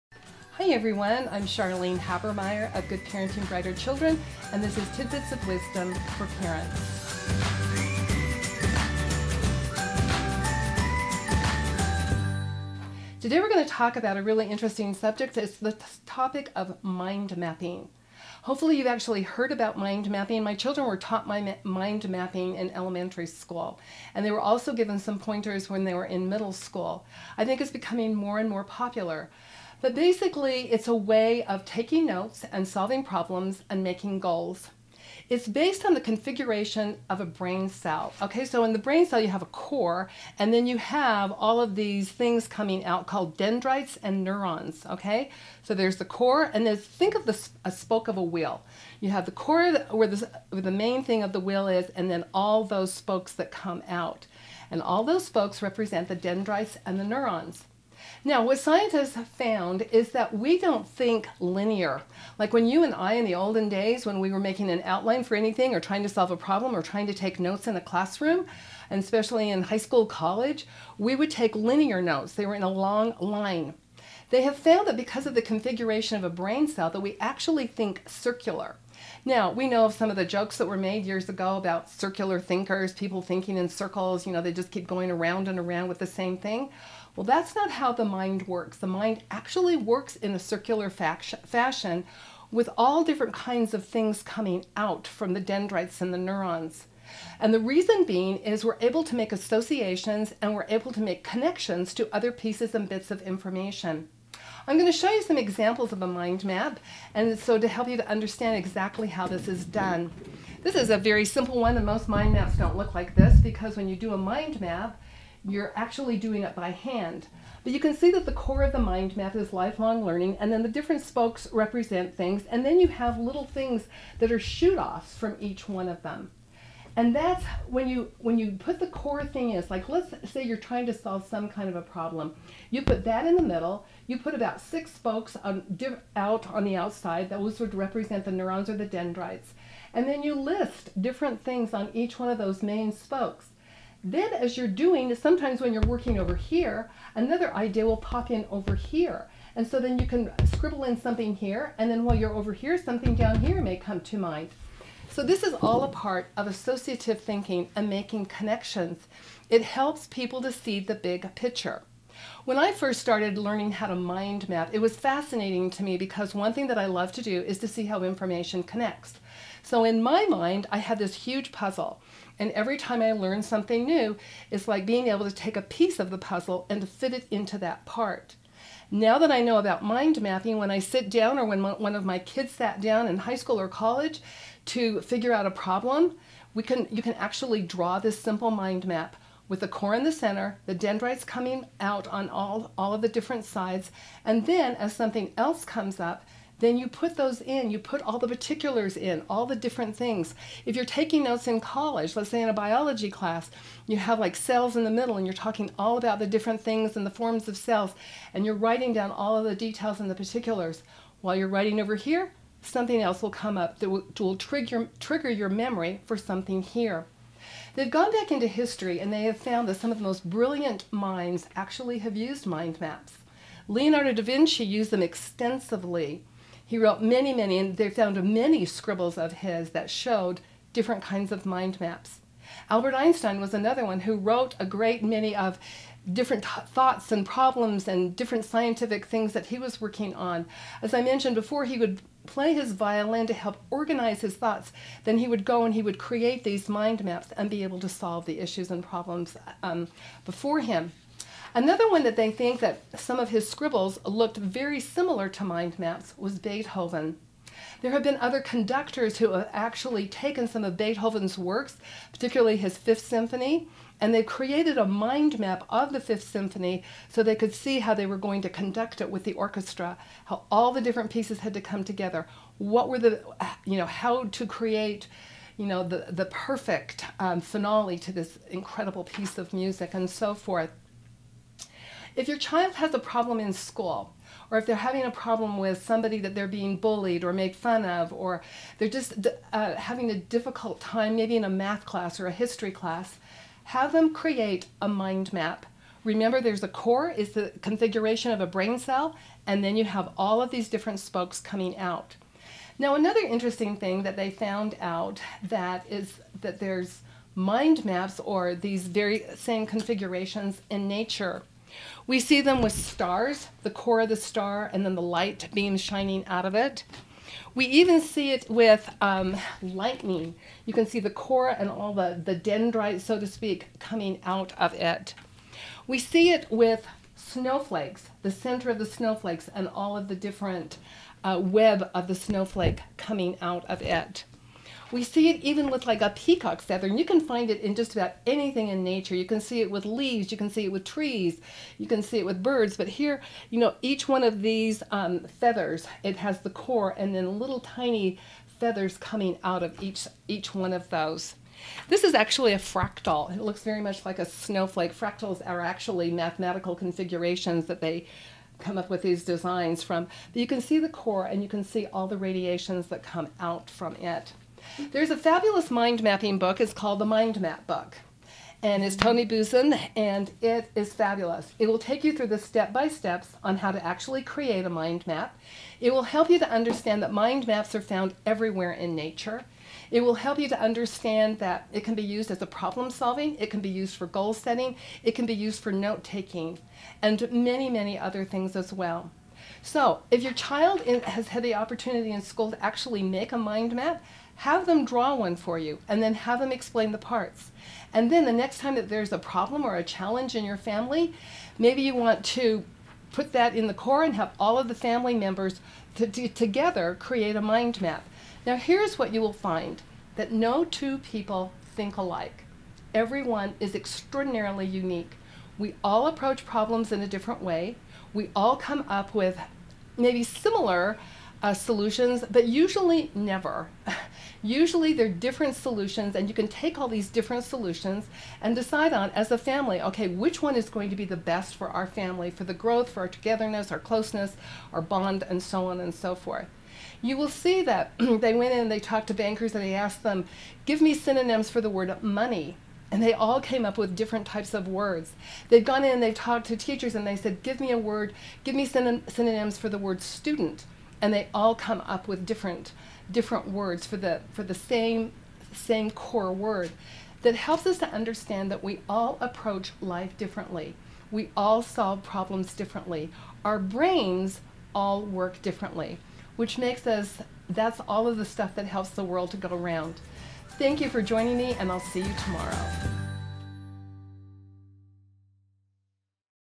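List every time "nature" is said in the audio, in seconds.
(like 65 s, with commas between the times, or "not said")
310 s, 338 s, 378 s.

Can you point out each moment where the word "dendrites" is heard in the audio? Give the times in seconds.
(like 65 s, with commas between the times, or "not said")
43 s, 56 s, 95 s, 138 s, 190 s, 322 s.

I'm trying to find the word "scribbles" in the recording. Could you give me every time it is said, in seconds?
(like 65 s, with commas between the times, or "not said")
150 s, 228 s, 253 s.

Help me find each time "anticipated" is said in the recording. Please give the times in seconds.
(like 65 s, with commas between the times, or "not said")
not said.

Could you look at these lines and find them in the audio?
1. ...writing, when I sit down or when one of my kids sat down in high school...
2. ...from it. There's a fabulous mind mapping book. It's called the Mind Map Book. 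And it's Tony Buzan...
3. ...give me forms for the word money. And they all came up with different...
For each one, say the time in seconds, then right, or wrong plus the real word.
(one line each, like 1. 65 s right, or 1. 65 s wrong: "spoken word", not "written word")
1. 180 s wrong: "mapping", not "writing"
2. 363 s right
3. 440 s wrong: "synonyms", not "forms".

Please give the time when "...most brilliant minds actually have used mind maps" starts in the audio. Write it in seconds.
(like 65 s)
220 s.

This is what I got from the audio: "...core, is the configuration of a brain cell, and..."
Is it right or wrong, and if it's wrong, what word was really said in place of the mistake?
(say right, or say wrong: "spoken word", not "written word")
right.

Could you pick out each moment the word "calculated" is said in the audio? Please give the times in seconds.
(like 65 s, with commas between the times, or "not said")
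not said.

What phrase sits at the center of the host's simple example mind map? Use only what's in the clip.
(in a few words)
Lifelong learning.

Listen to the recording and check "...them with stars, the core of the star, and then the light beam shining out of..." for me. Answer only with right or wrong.
right.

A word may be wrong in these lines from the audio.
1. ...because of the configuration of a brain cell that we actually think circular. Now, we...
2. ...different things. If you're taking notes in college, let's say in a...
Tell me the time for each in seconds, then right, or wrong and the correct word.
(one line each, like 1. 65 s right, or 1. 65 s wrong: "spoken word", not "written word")
1. 74 s right
2. 199 s right.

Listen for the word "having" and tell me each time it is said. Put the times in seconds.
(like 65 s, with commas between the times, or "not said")
284 s, 289 s.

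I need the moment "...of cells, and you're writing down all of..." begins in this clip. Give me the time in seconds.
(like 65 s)
207 s.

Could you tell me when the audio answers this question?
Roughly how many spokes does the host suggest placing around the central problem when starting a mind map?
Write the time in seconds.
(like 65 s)
134 s.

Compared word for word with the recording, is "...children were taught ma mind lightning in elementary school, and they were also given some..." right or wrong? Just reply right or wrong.
wrong.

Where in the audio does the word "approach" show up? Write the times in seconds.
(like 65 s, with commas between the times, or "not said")
416 s, 459 s.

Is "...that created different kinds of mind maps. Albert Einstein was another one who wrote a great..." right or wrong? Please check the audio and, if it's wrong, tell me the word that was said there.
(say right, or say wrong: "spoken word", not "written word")
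wrong: "showed", not "created".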